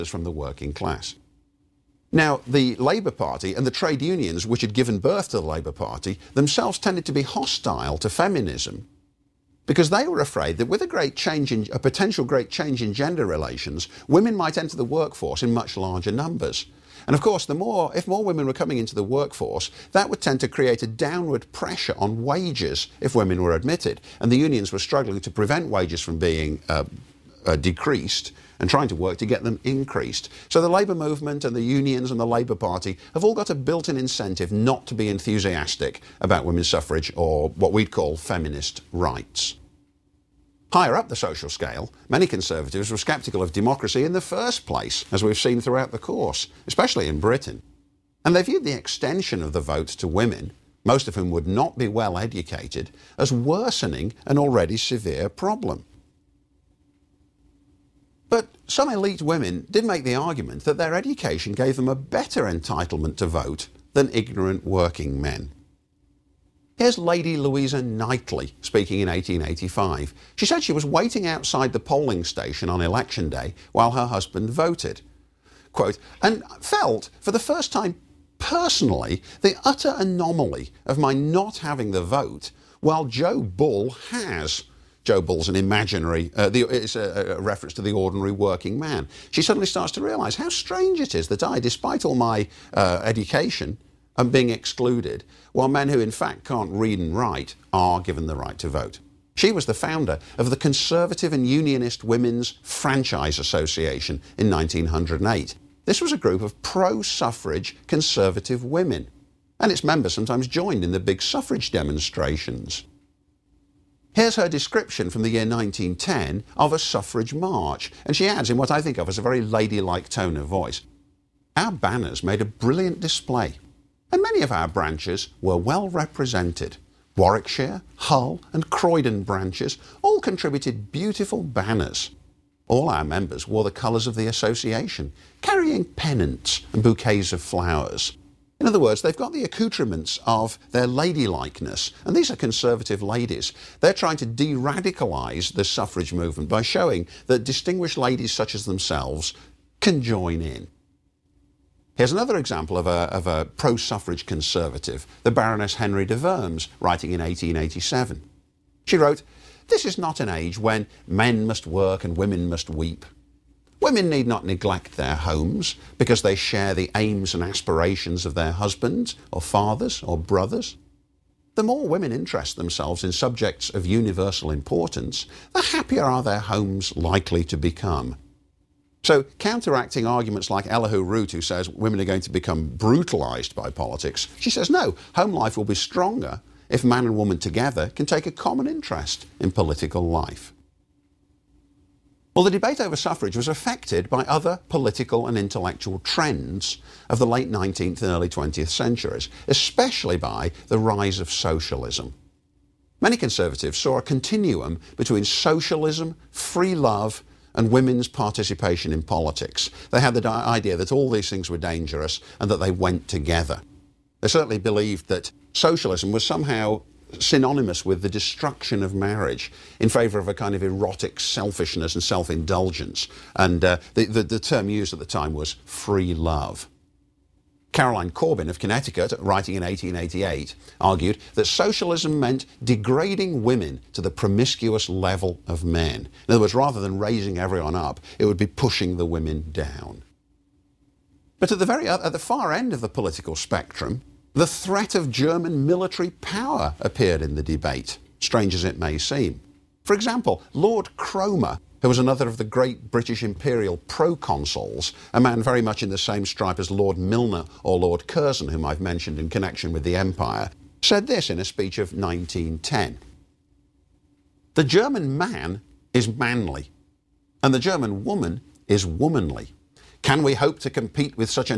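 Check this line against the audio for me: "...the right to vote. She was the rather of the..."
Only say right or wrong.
wrong.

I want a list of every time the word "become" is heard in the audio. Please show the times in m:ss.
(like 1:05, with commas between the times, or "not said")
2:57, 3:02.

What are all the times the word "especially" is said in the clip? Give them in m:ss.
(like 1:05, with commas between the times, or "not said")
0:46, 3:19.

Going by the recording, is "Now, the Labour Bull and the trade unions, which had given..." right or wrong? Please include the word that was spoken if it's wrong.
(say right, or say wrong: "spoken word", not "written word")
wrong: "Party", not "Bull".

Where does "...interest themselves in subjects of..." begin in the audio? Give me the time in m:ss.
2:52.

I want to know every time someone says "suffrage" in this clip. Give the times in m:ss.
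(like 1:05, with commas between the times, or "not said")
0:36, 1:47, 1:51, 1:56, 2:25, 2:33, 3:12.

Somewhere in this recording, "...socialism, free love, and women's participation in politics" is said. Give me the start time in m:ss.
3:25.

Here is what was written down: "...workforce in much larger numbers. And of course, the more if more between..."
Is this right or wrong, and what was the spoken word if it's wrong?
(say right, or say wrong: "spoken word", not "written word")
wrong: "women", not "between".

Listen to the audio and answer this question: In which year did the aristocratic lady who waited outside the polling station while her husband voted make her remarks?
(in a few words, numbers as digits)
1885.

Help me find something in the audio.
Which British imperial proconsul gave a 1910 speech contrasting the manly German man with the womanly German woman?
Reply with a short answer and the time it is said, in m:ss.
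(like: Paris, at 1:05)
Lord Cromer, at 4:10.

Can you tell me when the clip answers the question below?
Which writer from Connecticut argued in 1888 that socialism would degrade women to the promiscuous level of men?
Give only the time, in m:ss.
3:47.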